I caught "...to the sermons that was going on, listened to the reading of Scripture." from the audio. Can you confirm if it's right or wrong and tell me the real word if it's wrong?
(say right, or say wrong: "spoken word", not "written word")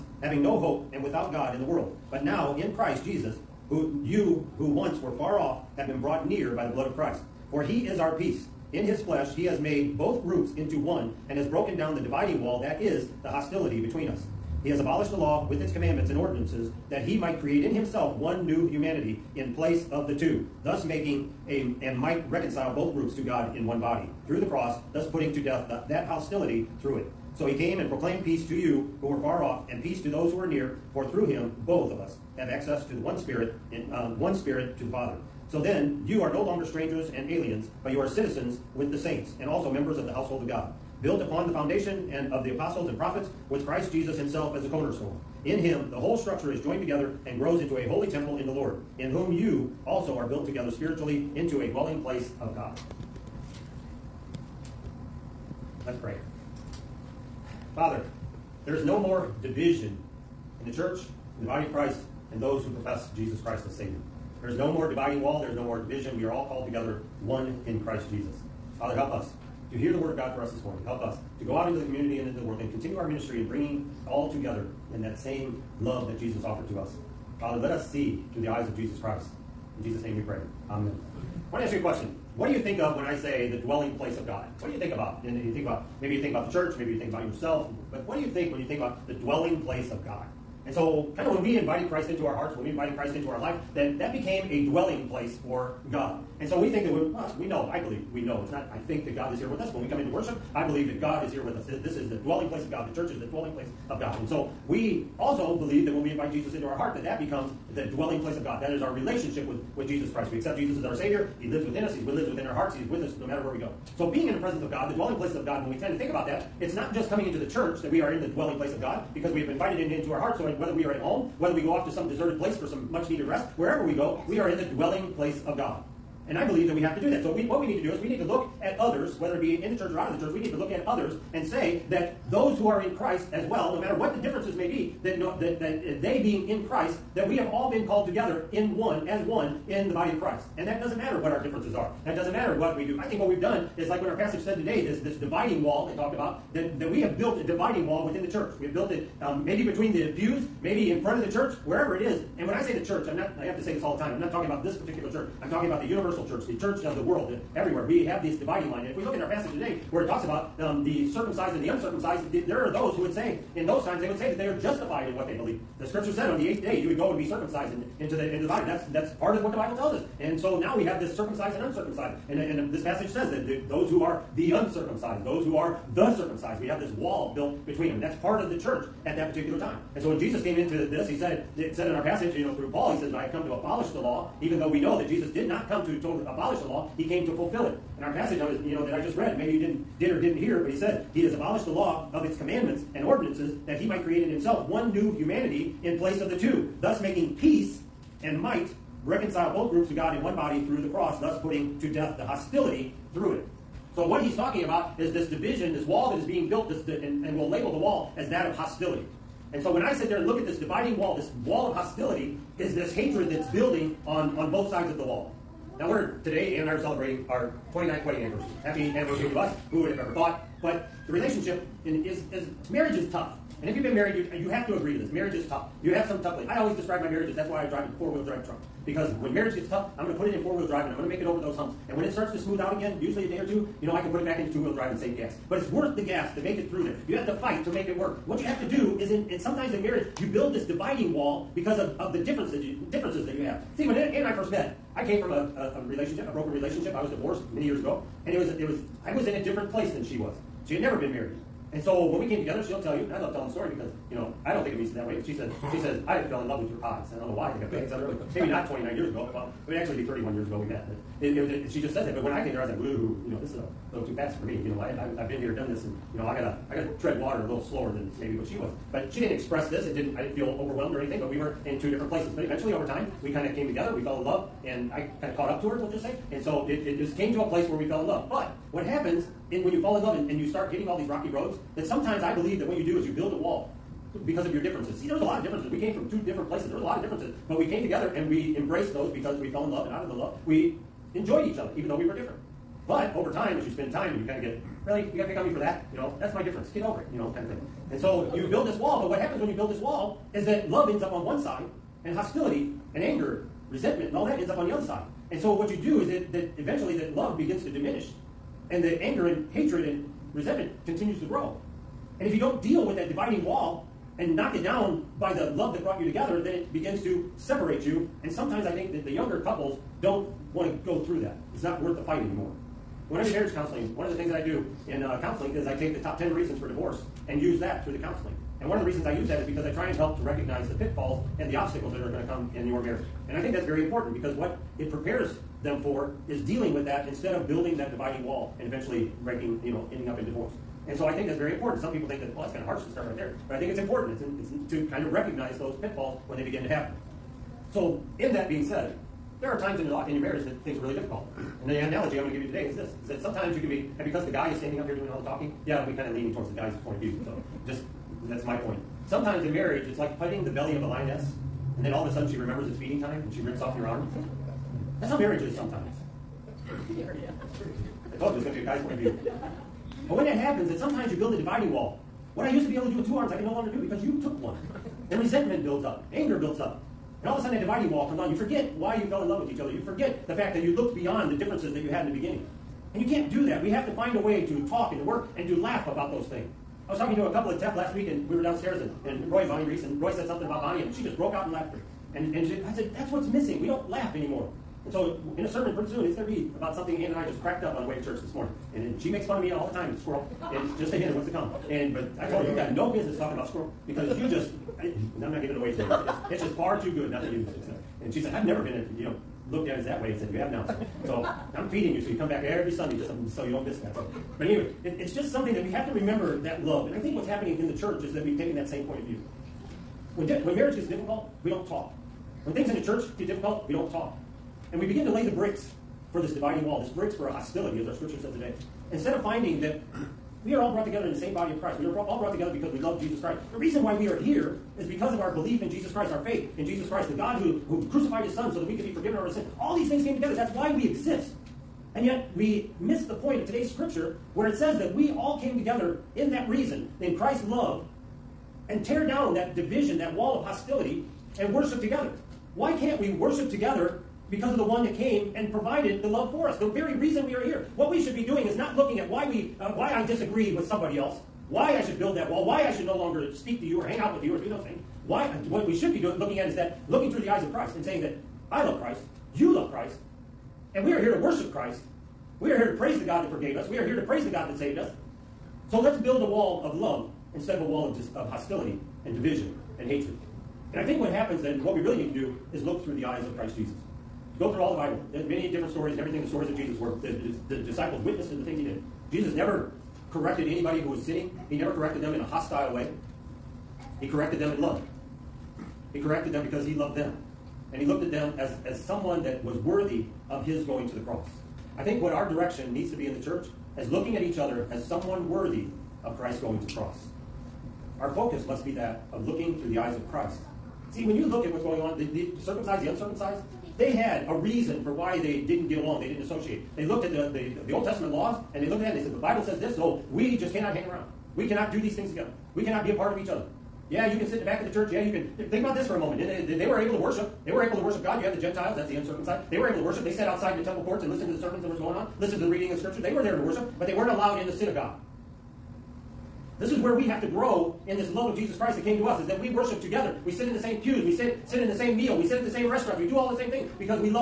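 right.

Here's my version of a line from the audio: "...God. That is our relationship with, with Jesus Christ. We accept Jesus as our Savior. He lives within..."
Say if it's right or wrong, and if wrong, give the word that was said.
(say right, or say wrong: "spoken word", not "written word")
right.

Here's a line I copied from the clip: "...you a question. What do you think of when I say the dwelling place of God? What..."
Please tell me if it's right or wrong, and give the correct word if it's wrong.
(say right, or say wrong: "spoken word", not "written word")
right.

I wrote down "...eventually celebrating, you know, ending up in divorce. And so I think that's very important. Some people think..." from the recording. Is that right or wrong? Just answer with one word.
wrong.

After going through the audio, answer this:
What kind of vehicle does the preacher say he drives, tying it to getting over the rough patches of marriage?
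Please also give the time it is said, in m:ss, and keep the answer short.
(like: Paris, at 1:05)
Four-wheel drive truck, at 3:47.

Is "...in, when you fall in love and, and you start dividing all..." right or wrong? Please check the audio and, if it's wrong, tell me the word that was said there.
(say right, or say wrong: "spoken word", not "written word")
wrong: "hitting", not "dividing".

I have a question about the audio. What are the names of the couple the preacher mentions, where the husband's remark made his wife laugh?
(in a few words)
Roy and Bonnie Reese.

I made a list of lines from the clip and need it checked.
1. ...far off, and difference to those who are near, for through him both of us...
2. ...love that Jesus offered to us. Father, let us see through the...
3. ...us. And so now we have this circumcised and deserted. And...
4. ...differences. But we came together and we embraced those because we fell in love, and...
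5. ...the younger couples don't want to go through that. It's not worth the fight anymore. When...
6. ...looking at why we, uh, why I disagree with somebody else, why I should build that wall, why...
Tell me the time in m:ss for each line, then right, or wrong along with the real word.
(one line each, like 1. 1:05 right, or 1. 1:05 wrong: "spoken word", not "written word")
1. 0:29 wrong: "peace", not "difference"
2. 1:15 right
3. 2:49 wrong: "uncircumcised", not "deserted"
4. 4:47 right
5. 5:19 right
6. 7:38 right.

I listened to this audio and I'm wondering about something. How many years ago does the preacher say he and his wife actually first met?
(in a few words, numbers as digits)
31.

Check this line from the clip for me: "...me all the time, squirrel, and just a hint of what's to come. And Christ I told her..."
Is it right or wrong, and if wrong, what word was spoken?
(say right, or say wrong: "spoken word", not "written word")
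wrong: "But", not "Christ".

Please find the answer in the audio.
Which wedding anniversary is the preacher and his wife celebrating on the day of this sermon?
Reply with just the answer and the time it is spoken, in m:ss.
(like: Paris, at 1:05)
29th, at 3:37.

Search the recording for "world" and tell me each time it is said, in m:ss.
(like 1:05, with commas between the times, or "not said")
0:01, 1:12, 2:37.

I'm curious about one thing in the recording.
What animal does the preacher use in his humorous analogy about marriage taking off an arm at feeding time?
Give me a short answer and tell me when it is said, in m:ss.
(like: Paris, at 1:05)
Lioness, at 6:00.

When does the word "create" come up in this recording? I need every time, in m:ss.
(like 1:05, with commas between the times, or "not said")
0:17, 3:14.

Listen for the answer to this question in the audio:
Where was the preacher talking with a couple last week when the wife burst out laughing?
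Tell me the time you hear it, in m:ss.
6:27.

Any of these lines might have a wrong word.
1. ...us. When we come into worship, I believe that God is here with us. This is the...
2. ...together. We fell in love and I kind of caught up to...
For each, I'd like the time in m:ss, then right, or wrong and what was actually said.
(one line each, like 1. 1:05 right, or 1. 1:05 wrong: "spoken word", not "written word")
1. 1:39 right
2. 4:33 right.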